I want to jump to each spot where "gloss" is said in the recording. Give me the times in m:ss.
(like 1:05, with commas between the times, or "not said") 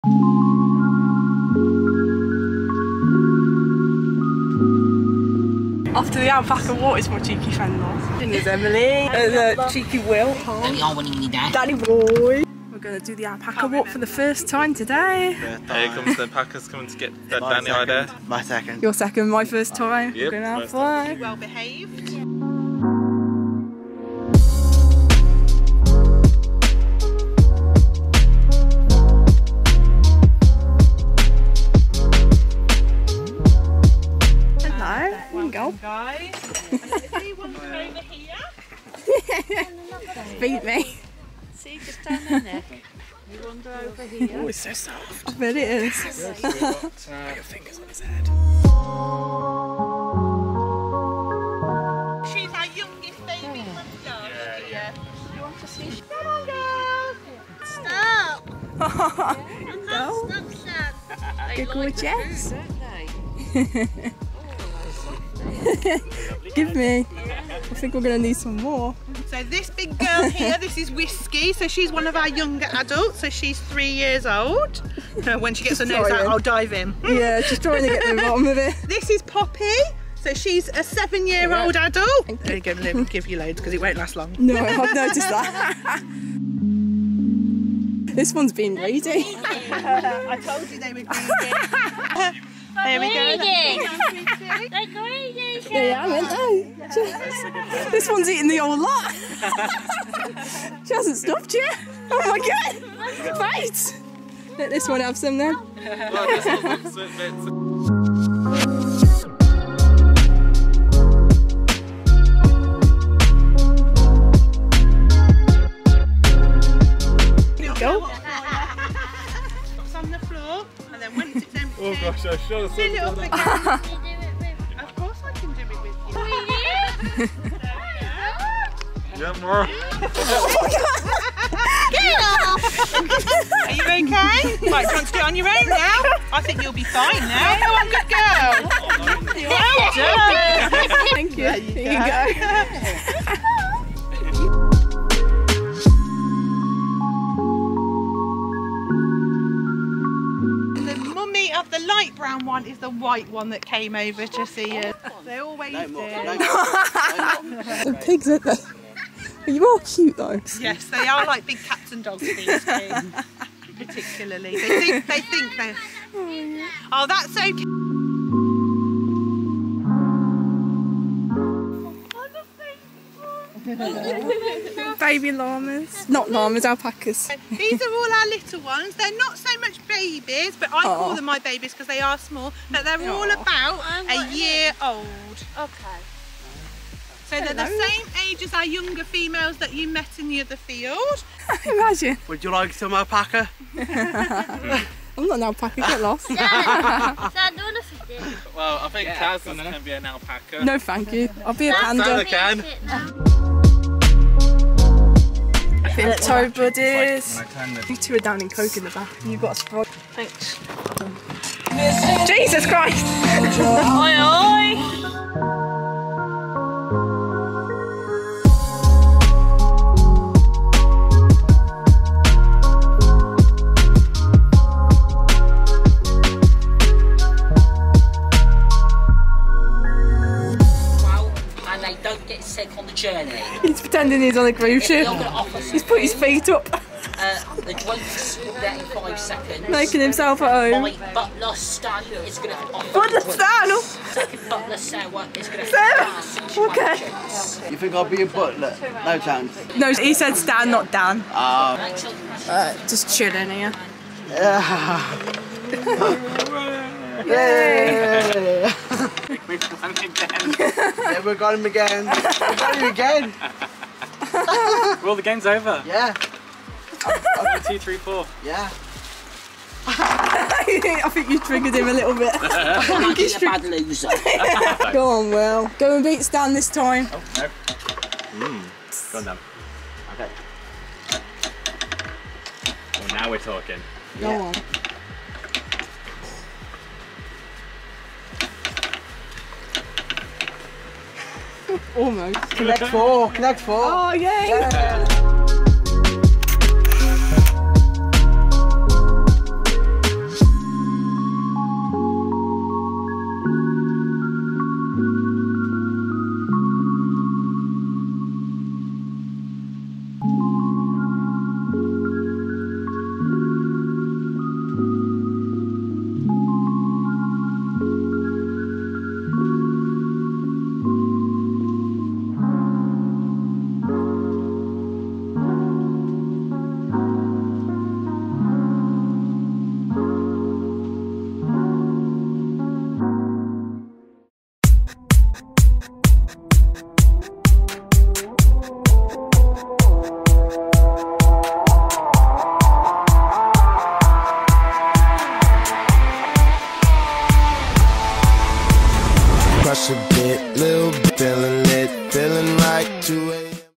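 not said.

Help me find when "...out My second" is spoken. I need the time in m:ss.
0:17.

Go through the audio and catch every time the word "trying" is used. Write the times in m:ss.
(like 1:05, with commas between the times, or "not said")
1:17.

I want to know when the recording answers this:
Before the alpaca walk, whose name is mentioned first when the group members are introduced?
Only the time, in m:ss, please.
0:08.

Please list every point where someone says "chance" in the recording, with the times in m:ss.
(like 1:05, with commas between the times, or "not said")
4:09.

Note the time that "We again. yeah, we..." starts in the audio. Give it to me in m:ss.
4:19.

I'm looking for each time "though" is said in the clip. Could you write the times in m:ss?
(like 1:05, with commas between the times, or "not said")
0:08, 2:40.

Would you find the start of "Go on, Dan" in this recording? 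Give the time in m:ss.
4:39.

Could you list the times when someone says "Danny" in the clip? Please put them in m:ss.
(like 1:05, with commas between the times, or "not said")
0:11, 0:17.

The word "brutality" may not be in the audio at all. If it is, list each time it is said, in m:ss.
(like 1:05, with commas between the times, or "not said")
not said.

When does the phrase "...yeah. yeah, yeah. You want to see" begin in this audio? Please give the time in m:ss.
0:53.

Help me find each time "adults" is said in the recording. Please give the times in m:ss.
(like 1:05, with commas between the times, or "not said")
1:12, 1:21.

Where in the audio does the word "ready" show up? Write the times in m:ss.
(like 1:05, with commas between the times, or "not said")
1:28.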